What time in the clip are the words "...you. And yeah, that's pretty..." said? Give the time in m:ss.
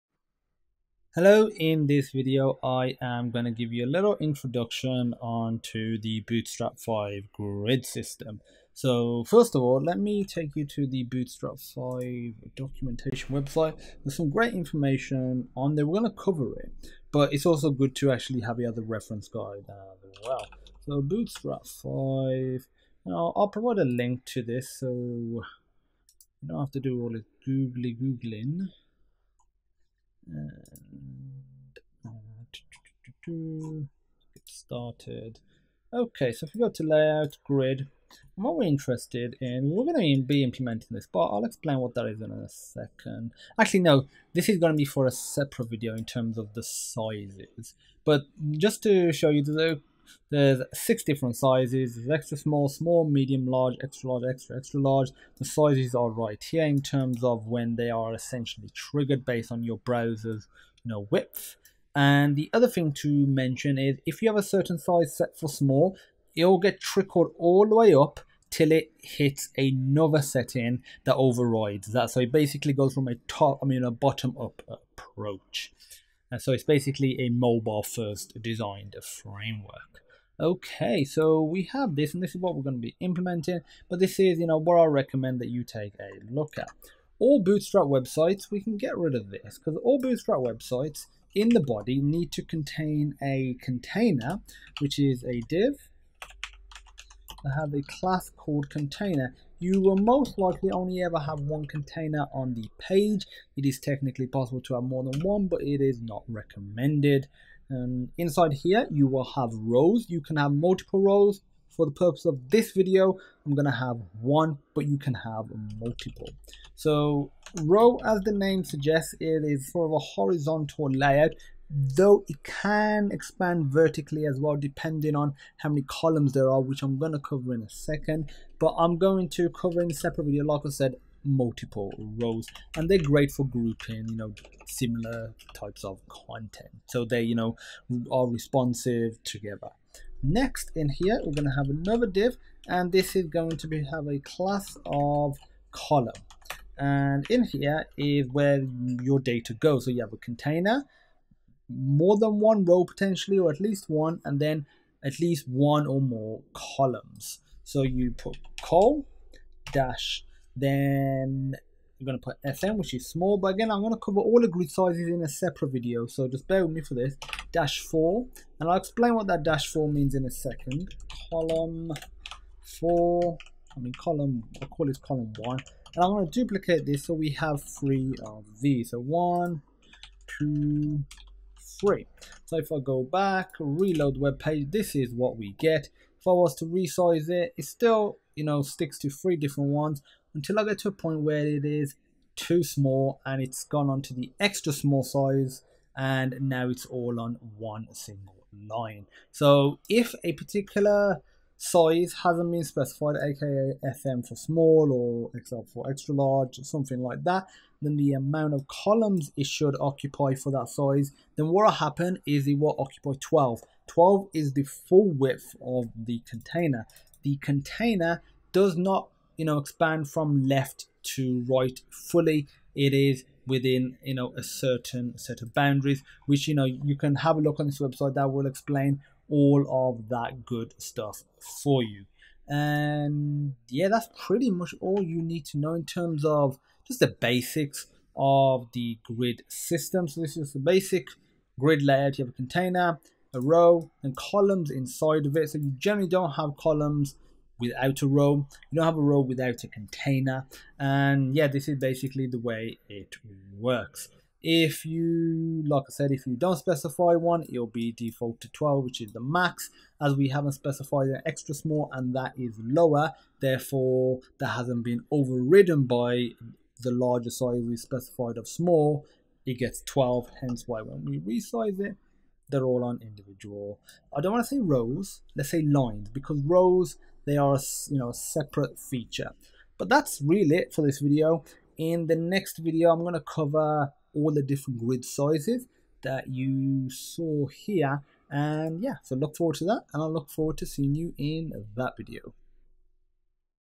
3:51.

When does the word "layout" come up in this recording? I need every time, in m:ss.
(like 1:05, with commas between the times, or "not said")
0:36, 2:00, 4:01.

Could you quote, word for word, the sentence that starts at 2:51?
Column 4, I mean column, I'll call this column 1.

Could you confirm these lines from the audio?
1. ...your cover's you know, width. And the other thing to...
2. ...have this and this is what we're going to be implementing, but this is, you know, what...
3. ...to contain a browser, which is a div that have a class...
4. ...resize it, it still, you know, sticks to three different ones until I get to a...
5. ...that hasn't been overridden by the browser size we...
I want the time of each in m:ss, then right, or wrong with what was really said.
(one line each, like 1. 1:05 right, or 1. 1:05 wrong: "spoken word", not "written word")
1. 0:59 wrong: "browser", not "cover"
2. 1:21 right
3. 1:32 wrong: "container", not "browser"
4. 3:06 right
5. 4:24 wrong: "larger", not "browser".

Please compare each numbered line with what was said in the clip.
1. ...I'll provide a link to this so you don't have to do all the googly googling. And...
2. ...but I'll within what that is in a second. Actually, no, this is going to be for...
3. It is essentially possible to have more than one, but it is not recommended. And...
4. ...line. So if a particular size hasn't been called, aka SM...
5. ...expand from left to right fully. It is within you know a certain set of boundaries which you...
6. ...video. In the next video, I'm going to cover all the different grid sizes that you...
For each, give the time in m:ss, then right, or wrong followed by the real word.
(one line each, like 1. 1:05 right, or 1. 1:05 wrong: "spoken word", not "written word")
1. 0:23 right
2. 0:41 wrong: "explain", not "within"
3. 1:43 wrong: "technically", not "essentially"
4. 3:18 wrong: "specified", not "called"
5. 3:39 right
6. 4:40 right.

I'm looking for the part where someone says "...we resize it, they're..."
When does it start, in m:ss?
4:31.